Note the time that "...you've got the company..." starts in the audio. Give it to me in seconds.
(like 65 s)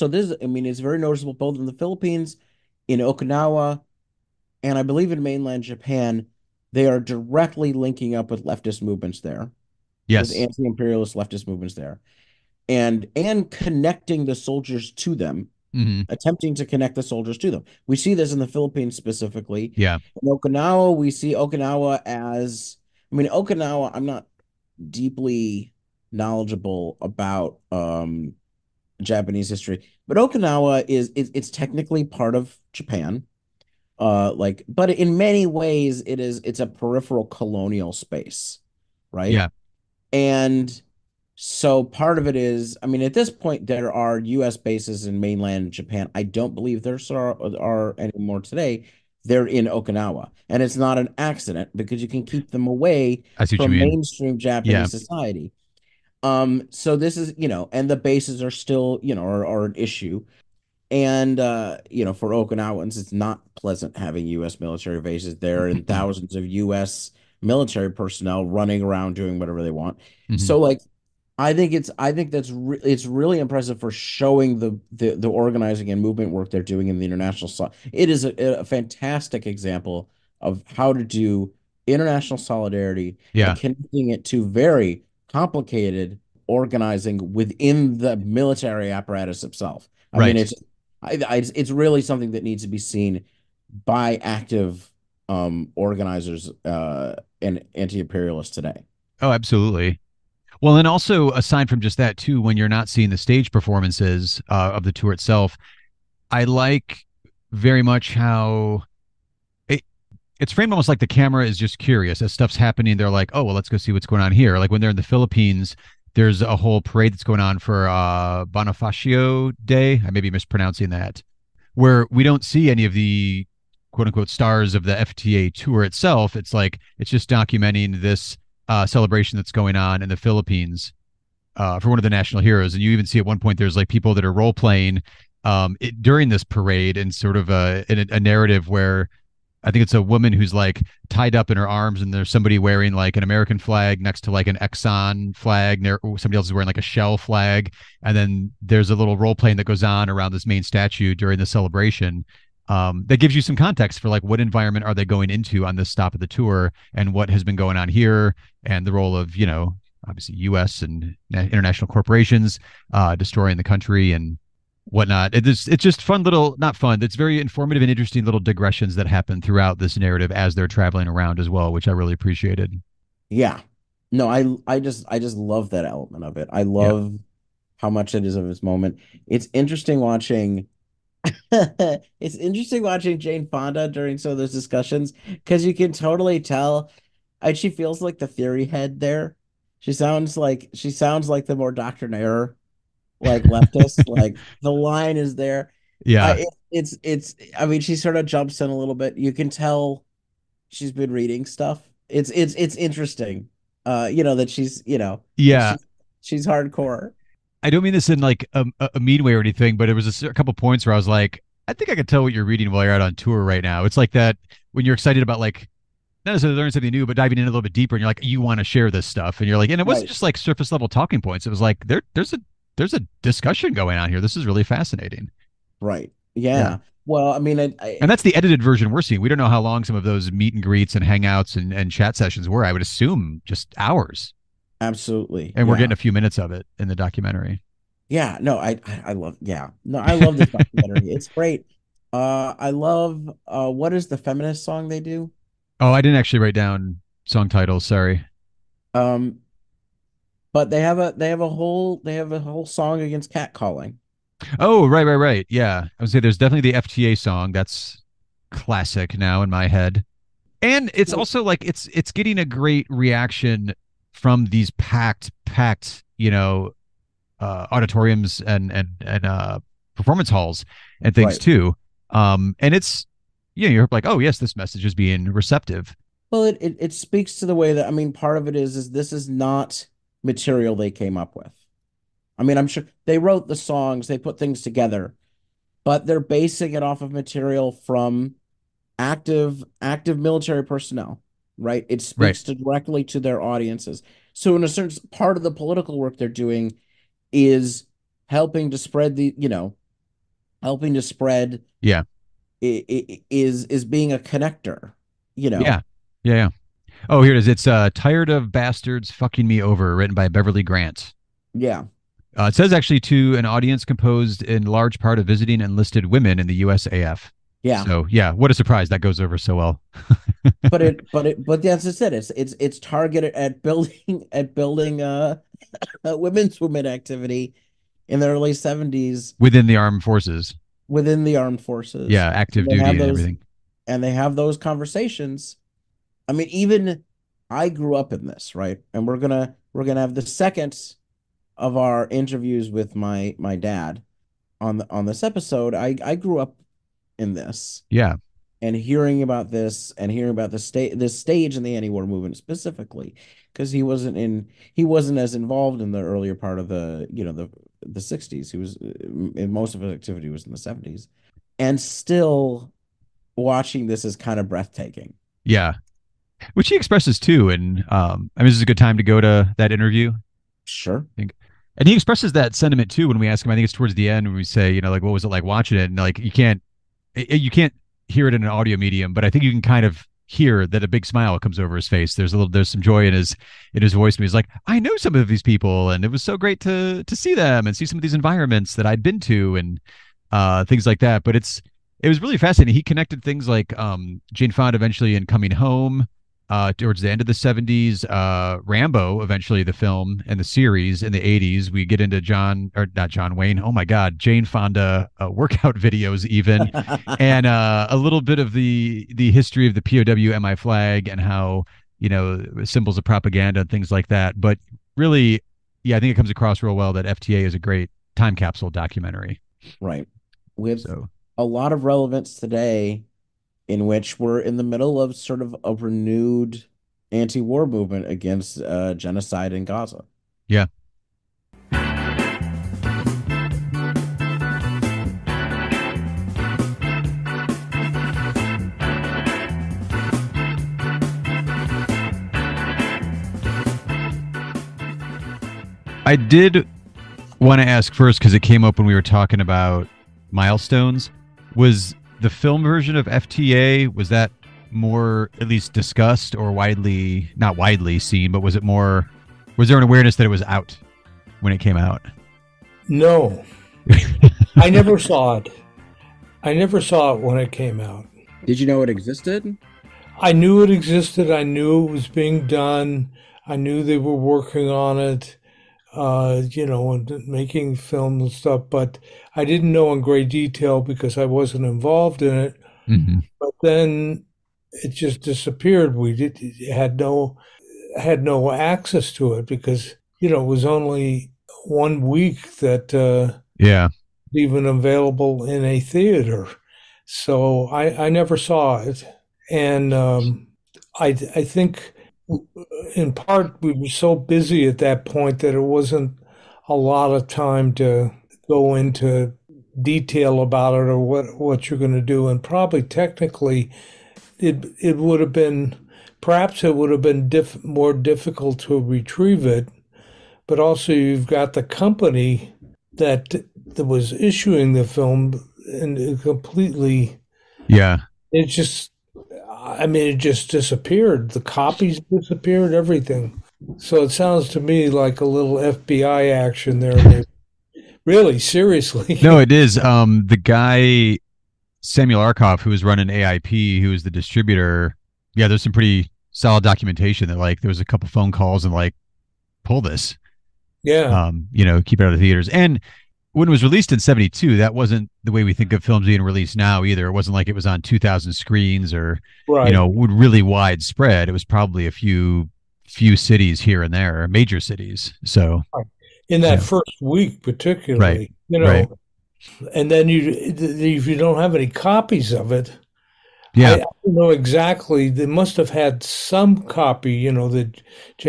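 520 s.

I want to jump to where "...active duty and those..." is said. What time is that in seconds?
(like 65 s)
332 s.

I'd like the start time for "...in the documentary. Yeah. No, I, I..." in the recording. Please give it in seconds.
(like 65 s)
236 s.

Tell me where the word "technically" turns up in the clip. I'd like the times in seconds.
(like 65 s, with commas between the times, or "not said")
31 s, 512 s.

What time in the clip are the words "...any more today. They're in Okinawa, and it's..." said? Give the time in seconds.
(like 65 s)
47 s.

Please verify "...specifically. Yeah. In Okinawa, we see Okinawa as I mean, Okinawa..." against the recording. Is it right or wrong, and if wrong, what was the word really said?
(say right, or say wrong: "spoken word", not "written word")
right.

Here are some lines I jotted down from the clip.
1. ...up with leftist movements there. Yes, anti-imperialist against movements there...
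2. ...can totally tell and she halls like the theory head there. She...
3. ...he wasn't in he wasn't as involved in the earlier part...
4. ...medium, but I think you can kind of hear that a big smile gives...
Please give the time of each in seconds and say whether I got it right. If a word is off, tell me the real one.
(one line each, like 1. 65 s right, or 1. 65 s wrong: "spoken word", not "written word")
1. 8 s wrong: "leftist", not "against"
2. 185 s wrong: "feels", not "halls"
3. 353 s right
4. 378 s wrong: "comes", not "gives".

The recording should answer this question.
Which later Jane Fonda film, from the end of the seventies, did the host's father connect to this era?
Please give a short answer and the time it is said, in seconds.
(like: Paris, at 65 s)
Coming Home, at 395 s.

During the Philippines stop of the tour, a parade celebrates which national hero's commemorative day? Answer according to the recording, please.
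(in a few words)
Bonifacio Day.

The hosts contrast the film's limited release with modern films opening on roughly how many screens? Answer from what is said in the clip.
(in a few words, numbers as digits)
2000.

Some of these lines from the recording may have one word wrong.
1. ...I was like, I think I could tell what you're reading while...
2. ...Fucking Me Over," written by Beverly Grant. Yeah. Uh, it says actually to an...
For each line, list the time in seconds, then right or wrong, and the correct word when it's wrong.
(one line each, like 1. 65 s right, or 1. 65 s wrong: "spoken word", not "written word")
1. 210 s right
2. 309 s right.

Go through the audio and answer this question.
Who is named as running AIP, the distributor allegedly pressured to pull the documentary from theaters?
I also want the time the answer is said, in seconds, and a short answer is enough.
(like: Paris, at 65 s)
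Samuel Arkoff, at 541 s.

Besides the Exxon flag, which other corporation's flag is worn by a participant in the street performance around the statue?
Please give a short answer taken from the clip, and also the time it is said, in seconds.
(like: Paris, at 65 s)
Shell, at 146 s.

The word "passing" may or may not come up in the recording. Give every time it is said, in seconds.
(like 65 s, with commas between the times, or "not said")
not said.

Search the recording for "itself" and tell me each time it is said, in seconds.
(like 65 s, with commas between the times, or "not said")
89 s, 105 s, 125 s.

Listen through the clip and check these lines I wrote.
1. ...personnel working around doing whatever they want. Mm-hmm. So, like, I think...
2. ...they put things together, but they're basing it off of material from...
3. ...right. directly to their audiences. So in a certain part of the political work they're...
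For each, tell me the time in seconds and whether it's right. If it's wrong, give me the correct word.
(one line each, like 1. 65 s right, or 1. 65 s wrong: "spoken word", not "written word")
1. 67 s wrong: "running", not "working"
2. 284 s right
3. 292 s right.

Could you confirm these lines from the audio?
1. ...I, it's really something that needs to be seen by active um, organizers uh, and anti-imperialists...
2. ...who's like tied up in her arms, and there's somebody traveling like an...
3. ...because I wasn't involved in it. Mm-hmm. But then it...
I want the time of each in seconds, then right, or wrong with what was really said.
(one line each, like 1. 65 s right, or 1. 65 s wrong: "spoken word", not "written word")
1. 91 s right
2. 140 s wrong: "wearing", not "traveling"
3. 480 s right.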